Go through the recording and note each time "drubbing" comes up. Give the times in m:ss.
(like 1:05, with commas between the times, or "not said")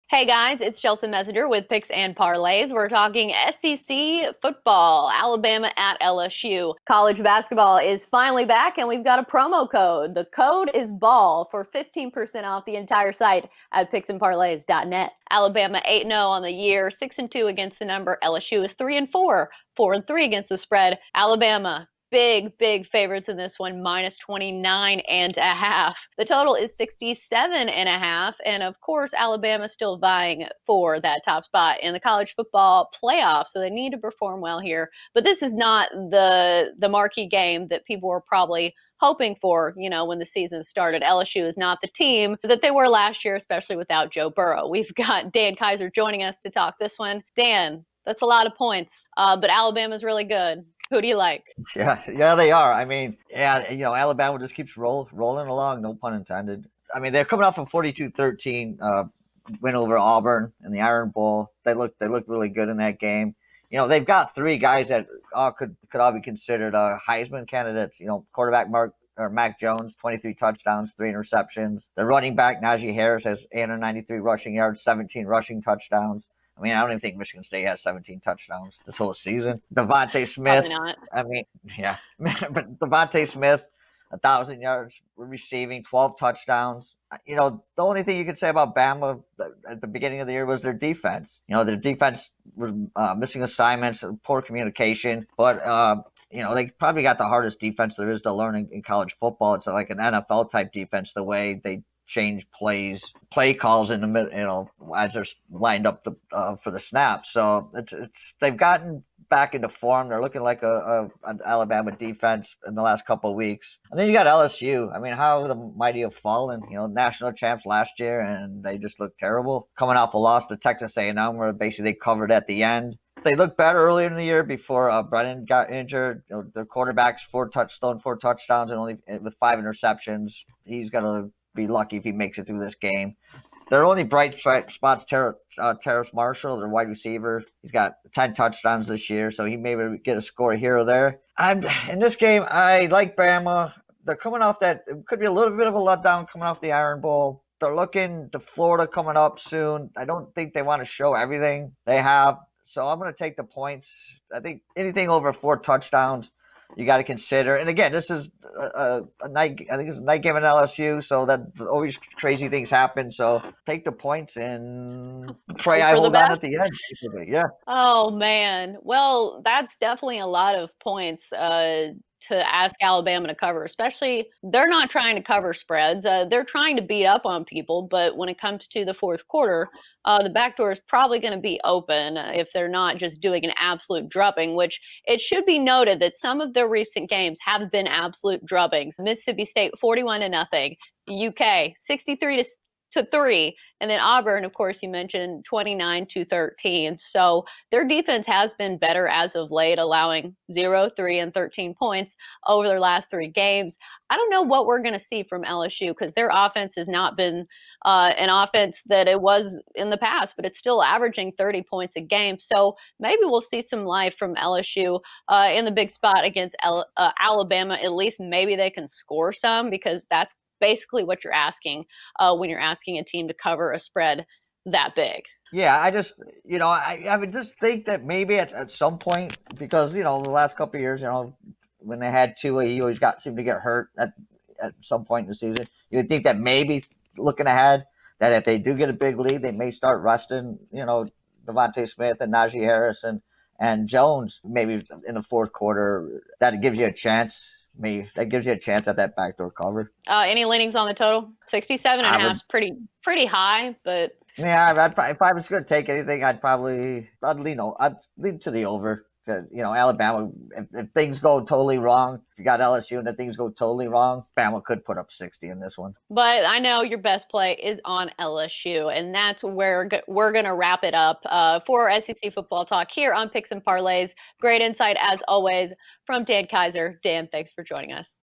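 3:04, 3:08.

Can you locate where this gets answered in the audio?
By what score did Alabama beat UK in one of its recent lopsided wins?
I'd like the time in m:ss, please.
3:11.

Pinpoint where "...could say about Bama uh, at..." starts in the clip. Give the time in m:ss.
1:28.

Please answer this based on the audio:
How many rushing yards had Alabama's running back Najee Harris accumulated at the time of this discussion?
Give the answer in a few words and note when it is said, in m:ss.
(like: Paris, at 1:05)
893, at 1:13.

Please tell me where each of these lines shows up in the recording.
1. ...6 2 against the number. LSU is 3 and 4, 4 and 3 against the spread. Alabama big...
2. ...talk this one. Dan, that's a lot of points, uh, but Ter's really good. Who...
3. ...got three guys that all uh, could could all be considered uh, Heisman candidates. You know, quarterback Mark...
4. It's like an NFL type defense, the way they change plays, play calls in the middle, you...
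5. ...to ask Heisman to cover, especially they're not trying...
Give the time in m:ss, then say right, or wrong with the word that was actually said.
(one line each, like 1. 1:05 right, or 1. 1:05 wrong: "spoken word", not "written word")
1. 0:16 right
2. 0:46 wrong: "Alabama", not "Ter"
3. 1:04 right
4. 1:39 right
5. 2:52 wrong: "Alabama", not "Heisman".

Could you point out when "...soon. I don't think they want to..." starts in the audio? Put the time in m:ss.
2:29.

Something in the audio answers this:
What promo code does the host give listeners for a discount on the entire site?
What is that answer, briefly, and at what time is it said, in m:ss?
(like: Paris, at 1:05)
BALL, at 0:10.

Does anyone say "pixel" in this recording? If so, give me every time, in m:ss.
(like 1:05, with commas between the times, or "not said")
not said.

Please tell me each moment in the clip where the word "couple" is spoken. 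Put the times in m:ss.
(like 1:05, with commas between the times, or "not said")
1:53, 3:50.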